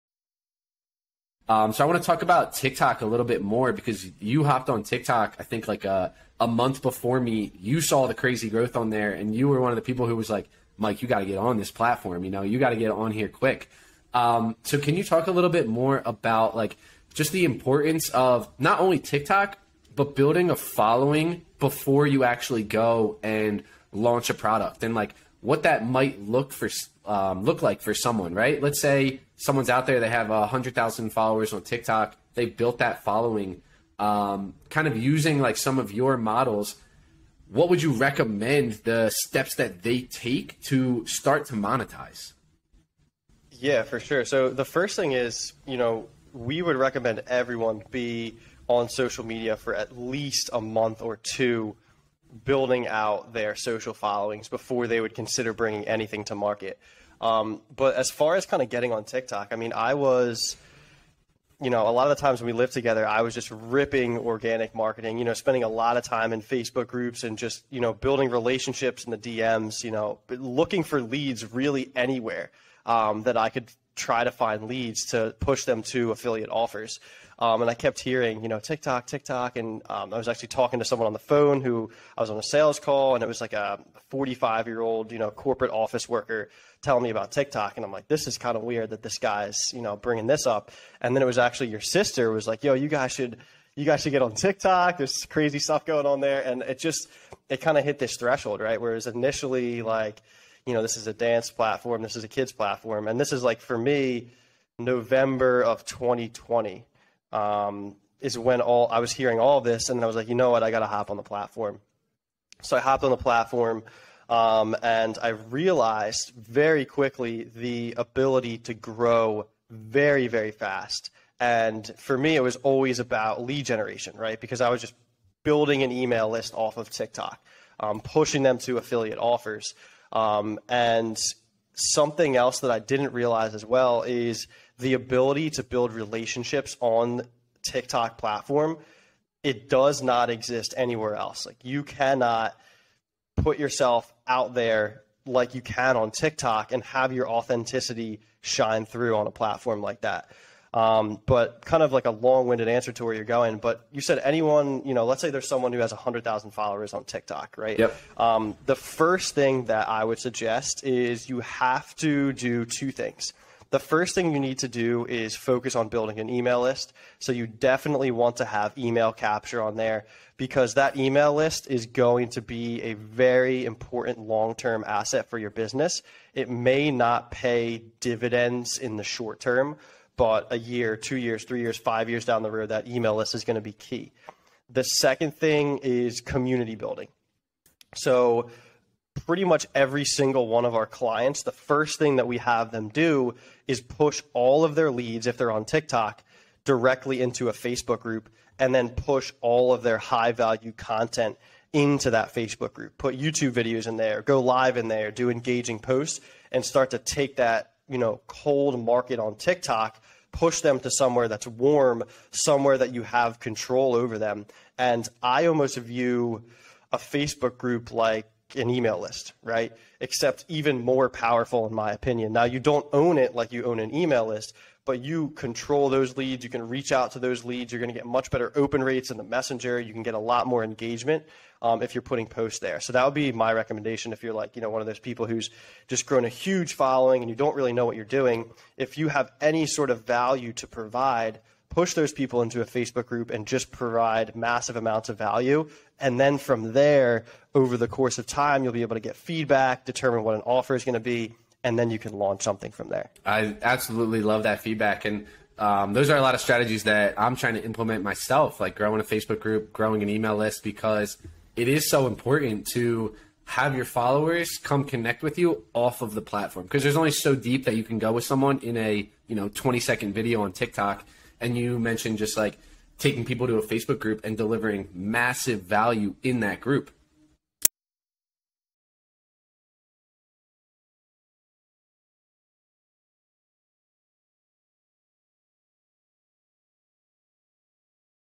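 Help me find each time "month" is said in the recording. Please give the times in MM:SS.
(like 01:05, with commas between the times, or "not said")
00:06, 00:50.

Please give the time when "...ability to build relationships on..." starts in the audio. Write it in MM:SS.
02:14.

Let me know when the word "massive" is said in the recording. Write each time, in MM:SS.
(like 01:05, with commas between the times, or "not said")
04:04, 04:34.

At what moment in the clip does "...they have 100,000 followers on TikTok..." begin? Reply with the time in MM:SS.
00:29.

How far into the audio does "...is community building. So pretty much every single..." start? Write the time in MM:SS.
03:05.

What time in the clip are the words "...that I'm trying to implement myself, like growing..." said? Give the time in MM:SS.
04:16.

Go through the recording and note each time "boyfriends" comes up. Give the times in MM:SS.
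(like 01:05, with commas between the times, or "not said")
not said.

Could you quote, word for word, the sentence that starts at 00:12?
You know, you got to get on here quick.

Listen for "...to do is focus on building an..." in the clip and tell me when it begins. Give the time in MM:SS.
02:44.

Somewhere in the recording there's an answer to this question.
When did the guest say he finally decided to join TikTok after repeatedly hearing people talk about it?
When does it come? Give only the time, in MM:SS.
01:44.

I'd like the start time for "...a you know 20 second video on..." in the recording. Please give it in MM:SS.
04:28.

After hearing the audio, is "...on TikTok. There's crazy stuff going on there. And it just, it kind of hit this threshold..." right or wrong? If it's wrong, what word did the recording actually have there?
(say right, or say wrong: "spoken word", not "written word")
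right.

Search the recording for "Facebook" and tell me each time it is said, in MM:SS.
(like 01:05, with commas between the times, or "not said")
01:06, 03:17, 03:22, 03:36, 04:02, 04:19, 04:33.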